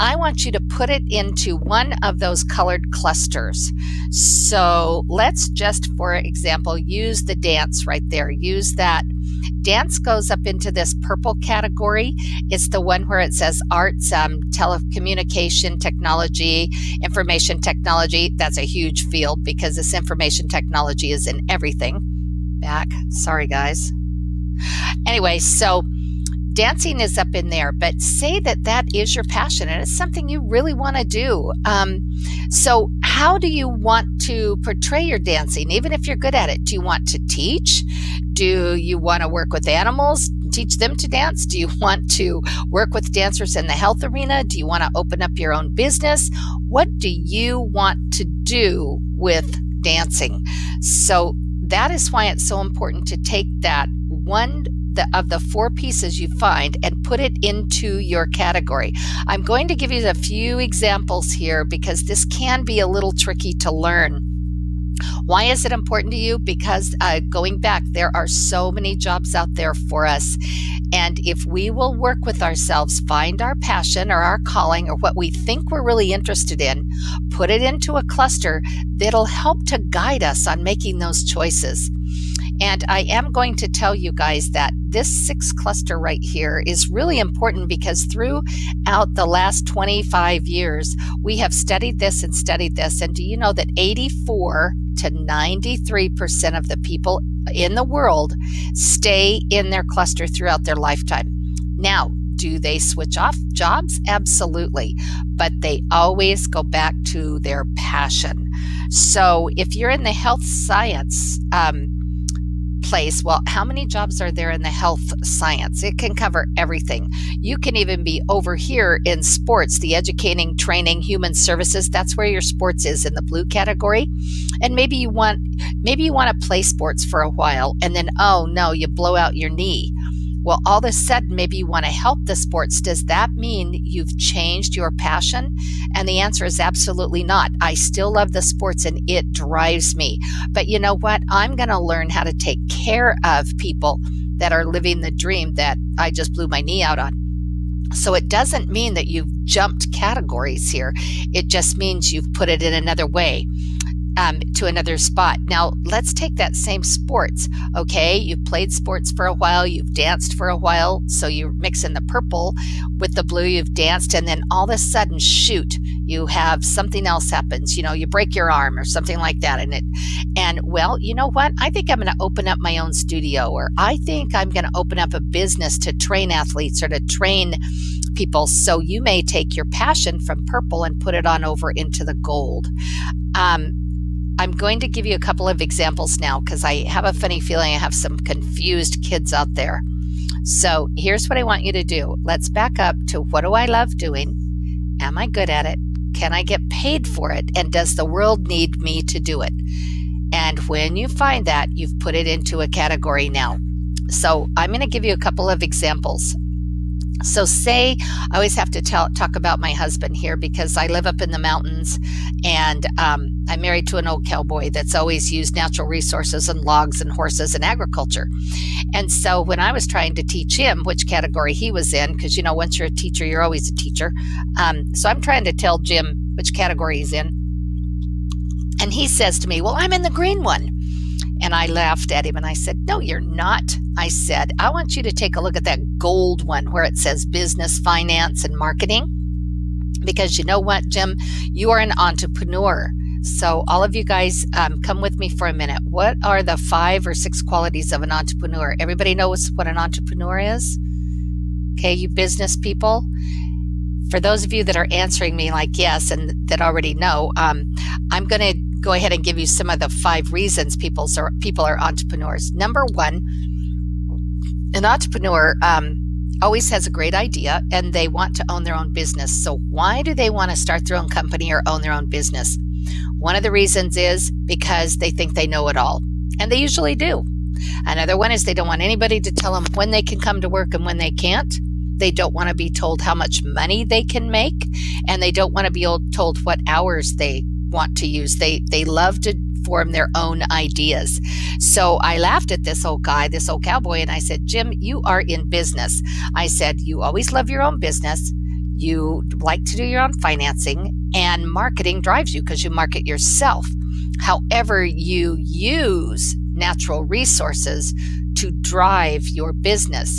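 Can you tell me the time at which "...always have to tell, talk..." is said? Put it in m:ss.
3:28.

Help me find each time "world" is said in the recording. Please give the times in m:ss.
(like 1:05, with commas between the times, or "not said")
1:37, 3:18.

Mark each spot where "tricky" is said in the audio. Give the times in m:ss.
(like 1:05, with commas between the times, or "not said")
1:03.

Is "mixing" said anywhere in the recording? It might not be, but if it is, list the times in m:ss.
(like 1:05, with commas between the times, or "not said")
2:41.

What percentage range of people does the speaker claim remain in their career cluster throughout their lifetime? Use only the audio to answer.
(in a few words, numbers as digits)
84 to 93%.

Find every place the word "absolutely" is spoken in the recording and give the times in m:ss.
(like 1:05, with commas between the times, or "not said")
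1:44, 2:16.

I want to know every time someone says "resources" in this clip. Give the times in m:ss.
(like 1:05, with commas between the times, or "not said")
3:35, 5:07.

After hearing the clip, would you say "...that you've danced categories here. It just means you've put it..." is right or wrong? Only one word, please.
wrong.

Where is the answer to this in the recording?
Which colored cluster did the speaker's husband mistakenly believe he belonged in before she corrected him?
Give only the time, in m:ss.
3:50.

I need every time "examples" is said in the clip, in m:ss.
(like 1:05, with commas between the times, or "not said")
0:06, 1:00, 3:05, 3:25.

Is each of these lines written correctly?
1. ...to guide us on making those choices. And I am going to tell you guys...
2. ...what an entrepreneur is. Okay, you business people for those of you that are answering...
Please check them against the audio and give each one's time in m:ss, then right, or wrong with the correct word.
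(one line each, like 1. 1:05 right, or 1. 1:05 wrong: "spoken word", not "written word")
1. 1:19 right
2. 4:09 right.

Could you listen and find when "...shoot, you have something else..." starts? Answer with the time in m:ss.
2:45.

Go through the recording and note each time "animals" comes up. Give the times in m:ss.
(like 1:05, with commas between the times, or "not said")
0:39.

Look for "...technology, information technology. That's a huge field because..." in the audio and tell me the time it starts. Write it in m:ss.
0:15.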